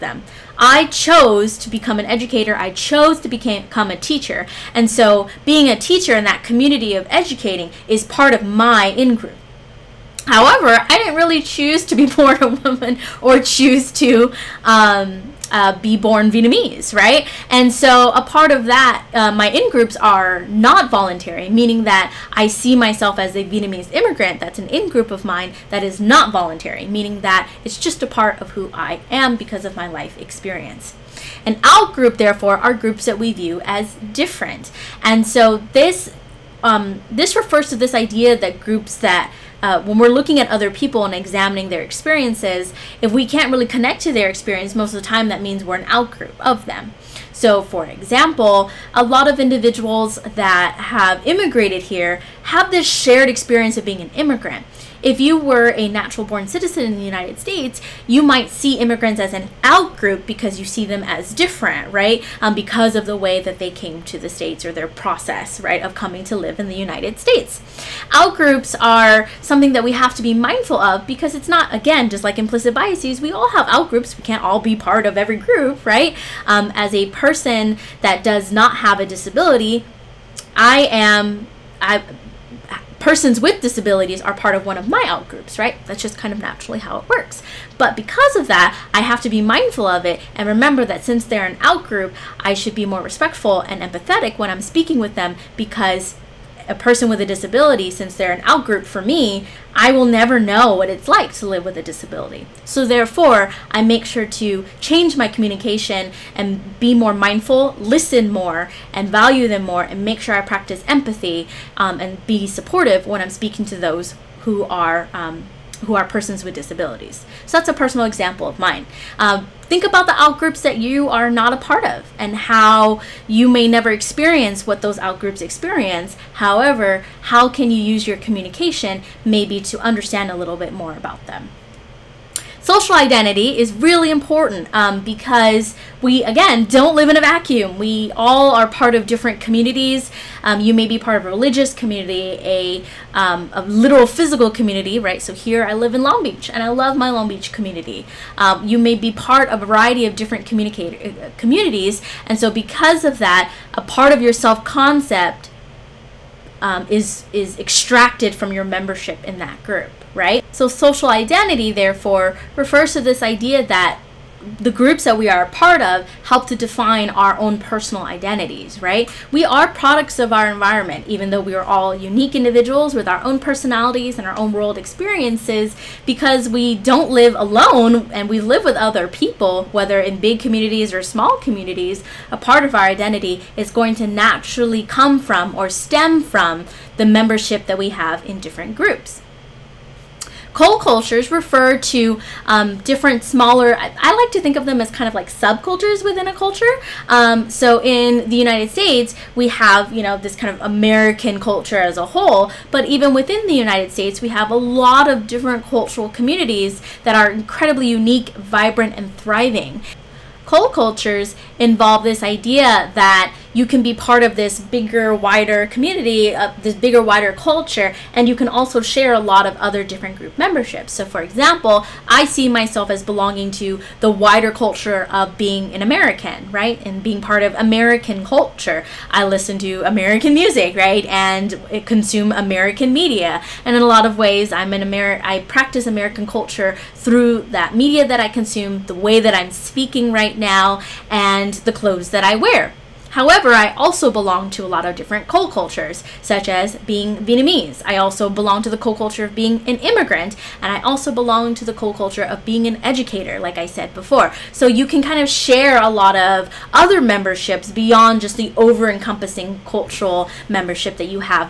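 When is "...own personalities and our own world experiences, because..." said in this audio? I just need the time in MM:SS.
02:53.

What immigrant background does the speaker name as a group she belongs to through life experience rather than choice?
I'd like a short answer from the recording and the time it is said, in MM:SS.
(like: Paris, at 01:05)
Vietnamese immigrant, at 00:23.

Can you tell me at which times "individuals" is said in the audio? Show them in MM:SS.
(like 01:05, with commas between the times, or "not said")
00:49, 02:52.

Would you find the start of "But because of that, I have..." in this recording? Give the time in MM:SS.
01:27.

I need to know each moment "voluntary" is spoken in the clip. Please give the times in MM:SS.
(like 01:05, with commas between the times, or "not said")
00:20, 00:26.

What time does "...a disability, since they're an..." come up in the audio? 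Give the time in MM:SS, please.
01:37.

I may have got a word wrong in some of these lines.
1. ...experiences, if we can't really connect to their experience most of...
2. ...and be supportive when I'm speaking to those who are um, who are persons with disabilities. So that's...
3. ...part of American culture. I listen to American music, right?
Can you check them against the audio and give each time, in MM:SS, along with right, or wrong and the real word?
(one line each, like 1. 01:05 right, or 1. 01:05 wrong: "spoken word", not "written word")
1. 00:41 right
2. 01:51 right
3. 03:47 right.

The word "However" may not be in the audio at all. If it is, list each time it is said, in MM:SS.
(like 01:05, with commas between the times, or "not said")
00:10, 02:06, 04:03.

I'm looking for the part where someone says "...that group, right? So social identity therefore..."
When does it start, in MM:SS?
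02:39.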